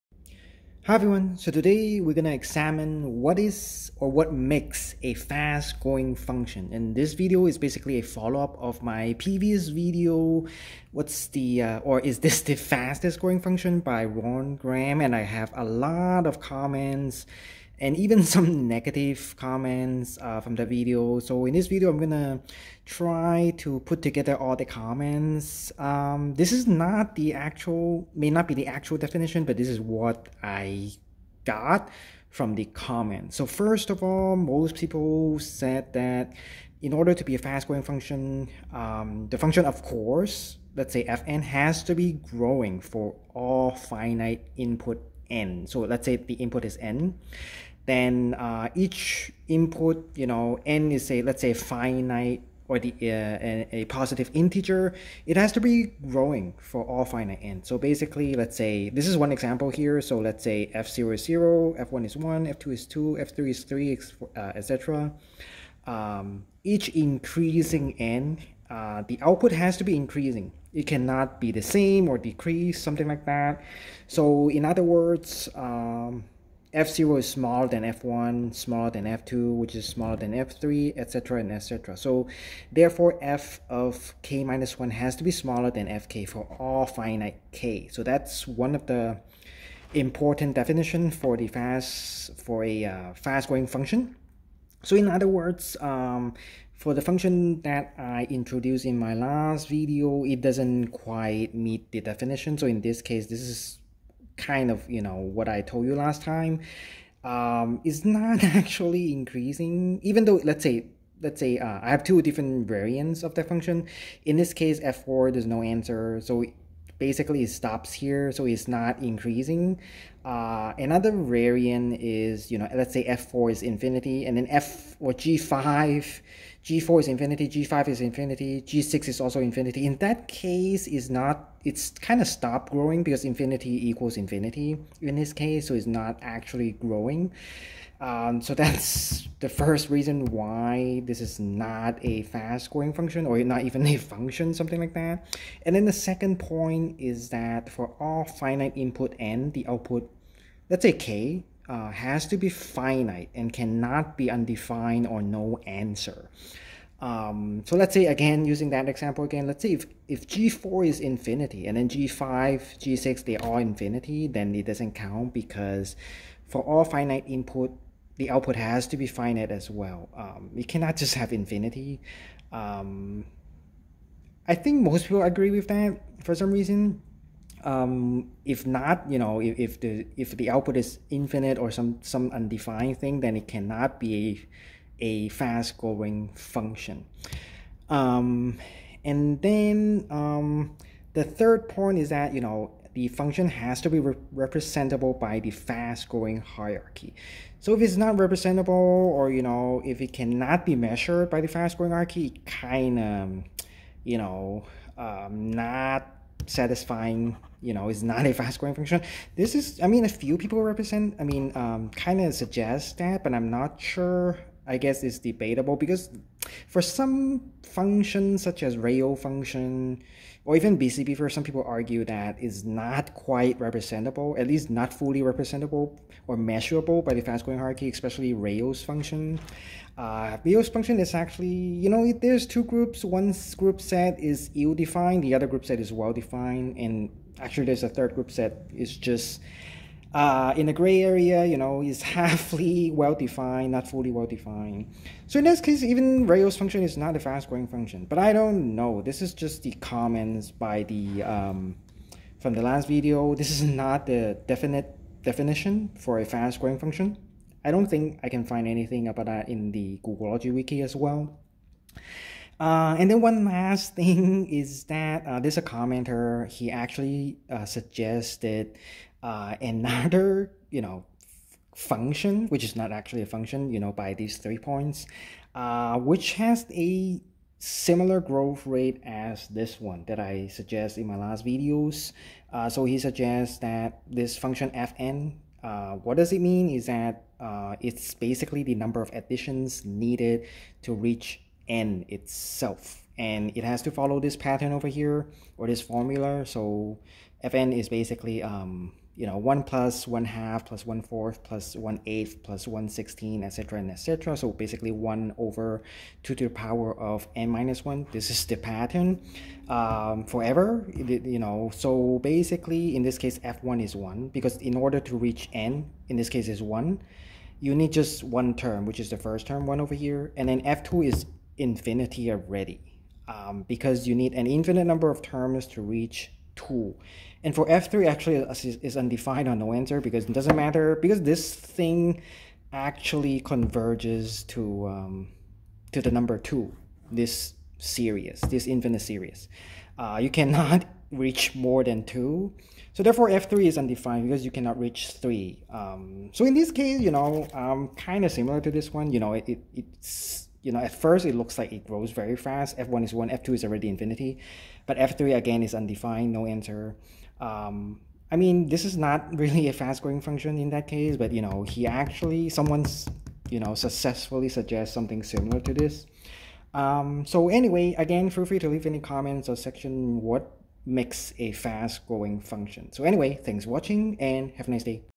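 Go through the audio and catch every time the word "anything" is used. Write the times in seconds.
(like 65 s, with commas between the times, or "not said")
258 s.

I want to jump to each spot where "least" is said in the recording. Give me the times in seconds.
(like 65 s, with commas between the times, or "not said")
224 s.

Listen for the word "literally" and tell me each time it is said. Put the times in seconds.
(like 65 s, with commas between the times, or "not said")
not said.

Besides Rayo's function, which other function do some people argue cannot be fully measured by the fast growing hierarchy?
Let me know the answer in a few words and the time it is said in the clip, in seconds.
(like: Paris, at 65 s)
BCP, at 220 s.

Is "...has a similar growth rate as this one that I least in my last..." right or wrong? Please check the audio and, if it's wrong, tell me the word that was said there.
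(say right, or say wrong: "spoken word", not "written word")
wrong: "suggest", not "least".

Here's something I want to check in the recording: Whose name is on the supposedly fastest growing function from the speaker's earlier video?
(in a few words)
Ron Graham.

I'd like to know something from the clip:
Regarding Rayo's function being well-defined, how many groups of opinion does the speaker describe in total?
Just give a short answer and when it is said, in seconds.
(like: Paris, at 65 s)
3, at 237 s.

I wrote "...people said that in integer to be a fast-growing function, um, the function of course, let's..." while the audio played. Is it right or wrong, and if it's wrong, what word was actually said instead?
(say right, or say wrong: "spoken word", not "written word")
wrong: "order", not "integer".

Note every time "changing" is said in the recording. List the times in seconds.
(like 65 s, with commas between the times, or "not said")
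not said.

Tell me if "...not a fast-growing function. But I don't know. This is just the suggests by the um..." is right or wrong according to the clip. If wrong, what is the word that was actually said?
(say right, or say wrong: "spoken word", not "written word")
wrong: "comments", not "suggests".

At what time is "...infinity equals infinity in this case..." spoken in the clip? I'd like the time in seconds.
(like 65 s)
133 s.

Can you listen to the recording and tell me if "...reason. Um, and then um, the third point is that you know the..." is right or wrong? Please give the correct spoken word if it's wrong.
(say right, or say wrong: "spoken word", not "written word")
wrong: "function", not "reason".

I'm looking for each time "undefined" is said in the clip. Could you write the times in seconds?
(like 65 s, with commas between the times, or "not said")
154 s, 182 s, 328 s, 343 s, 355 s.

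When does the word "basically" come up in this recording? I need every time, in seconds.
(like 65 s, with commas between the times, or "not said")
7 s, 57 s, 117 s, 288 s, 297 s, 304 s, 312 s.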